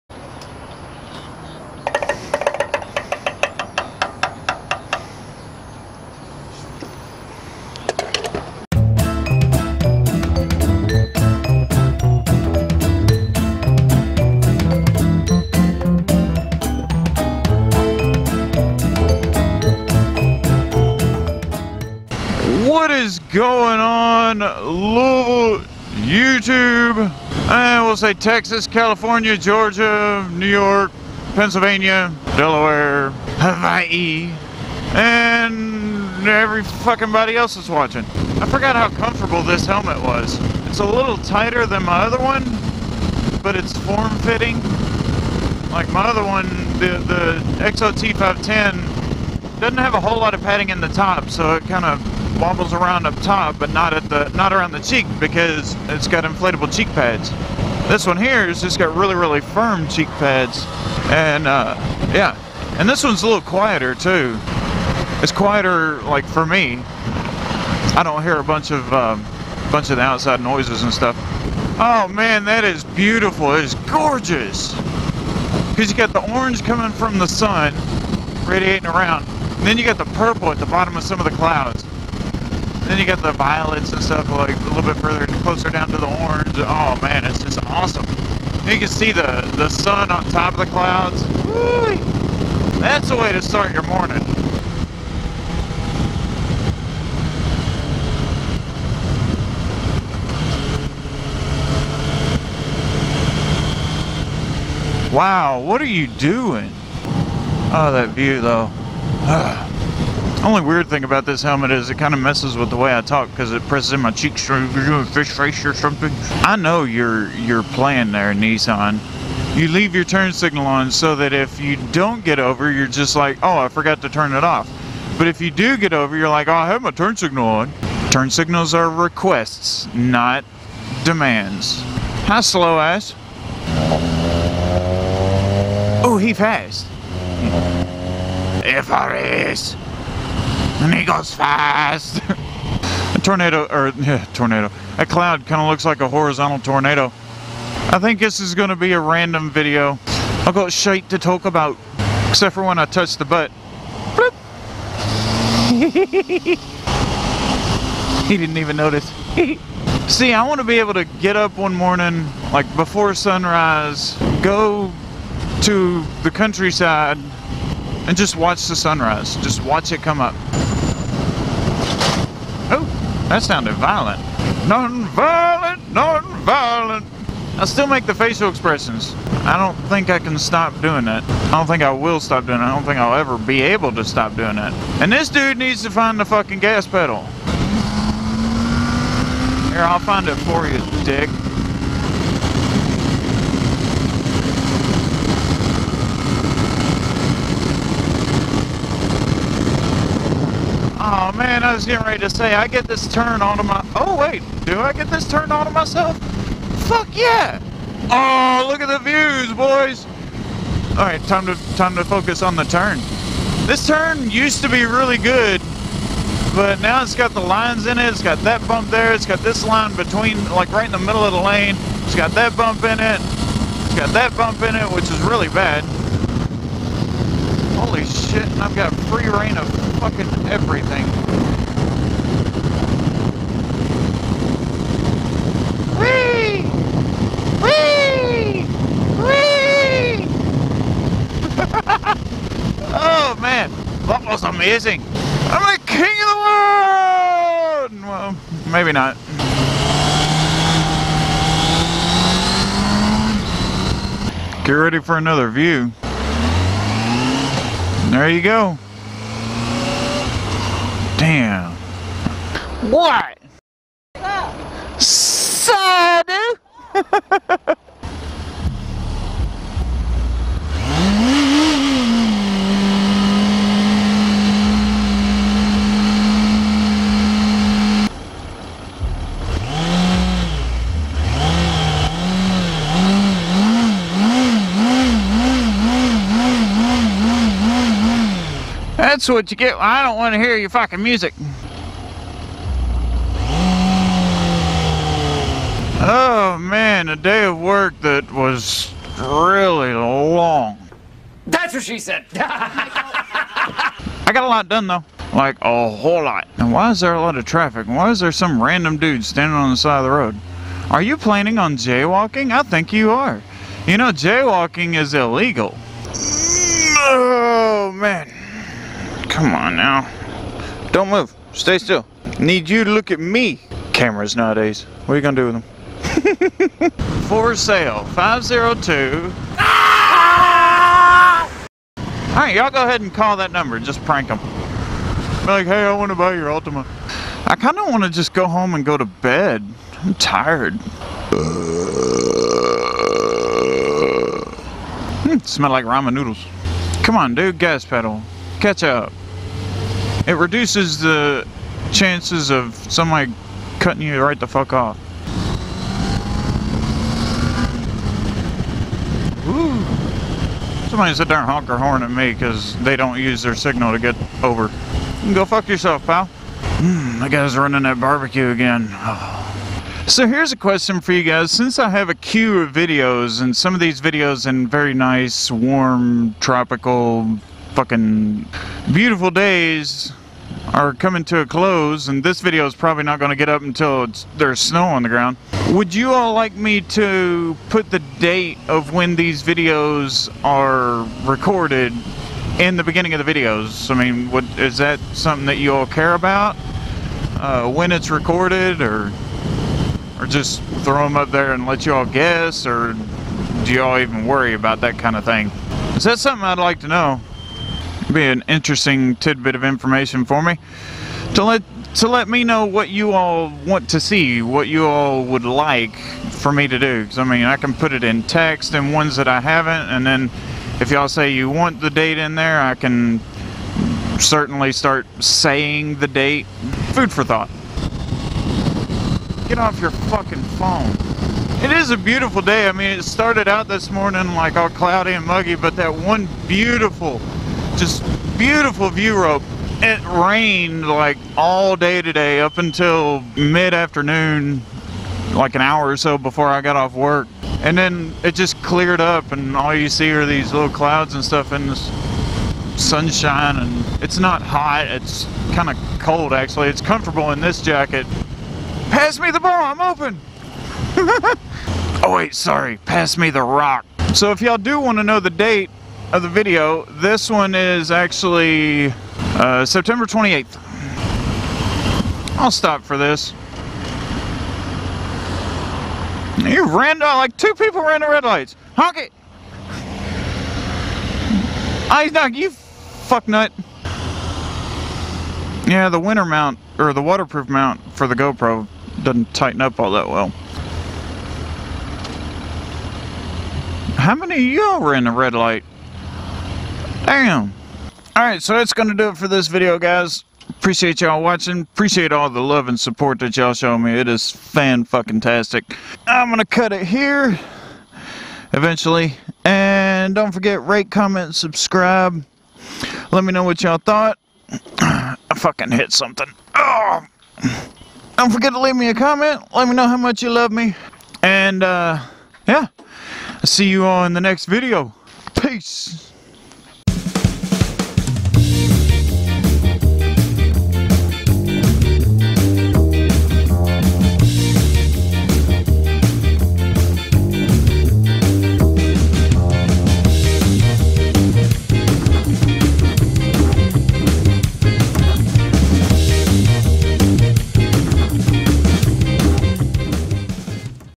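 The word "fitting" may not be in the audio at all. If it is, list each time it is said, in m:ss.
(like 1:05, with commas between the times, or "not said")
0:43.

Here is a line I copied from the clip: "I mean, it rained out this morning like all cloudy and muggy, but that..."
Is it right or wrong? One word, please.
wrong.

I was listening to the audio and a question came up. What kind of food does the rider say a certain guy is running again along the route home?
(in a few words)
Barbecue.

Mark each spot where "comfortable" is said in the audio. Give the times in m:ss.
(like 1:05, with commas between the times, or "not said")
0:38, 7:36.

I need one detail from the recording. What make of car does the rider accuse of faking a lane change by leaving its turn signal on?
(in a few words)
Nissan.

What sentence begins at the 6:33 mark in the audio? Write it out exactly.
I mean, what, is that something that you all care about?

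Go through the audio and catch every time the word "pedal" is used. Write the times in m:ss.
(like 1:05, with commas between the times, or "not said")
3:06, 5:47.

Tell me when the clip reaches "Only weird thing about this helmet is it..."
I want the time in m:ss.
1:50.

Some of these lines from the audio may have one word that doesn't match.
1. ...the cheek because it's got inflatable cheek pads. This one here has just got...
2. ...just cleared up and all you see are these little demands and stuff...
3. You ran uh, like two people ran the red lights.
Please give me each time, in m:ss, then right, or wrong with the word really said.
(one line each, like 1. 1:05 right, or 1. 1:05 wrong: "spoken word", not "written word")
1. 0:54 right
2. 7:28 wrong: "clouds", not "demands"
3. 7:56 right.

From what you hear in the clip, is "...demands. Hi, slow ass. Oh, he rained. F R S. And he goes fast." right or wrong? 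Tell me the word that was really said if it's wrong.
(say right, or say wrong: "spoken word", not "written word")
wrong: "passed", not "rained".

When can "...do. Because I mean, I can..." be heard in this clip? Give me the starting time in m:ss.
6:56.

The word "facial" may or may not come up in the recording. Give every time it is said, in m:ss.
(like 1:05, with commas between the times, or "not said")
2:58.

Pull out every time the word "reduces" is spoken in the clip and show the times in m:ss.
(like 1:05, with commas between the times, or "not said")
5:50.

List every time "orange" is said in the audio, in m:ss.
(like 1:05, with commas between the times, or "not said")
1:16, 1:26.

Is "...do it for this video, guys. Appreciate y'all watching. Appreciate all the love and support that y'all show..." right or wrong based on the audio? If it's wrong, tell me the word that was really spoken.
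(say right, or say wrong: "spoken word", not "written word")
right.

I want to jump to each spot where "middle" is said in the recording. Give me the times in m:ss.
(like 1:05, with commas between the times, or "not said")
3:40.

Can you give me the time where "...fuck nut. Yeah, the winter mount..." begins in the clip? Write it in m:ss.
8:02.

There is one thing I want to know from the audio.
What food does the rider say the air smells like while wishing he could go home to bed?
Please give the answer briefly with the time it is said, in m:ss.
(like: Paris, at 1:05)
Ramen noodles, at 5:45.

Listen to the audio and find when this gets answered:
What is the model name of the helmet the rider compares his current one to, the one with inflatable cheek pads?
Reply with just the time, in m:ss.
0:47.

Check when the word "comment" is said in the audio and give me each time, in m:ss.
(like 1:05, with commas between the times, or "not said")
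8:30, 8:38.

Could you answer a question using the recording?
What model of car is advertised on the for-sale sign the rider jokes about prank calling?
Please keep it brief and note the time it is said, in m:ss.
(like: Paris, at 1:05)
Altima, at 5:36.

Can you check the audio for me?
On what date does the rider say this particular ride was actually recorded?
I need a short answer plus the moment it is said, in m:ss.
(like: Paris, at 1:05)
September 28, at 7:49.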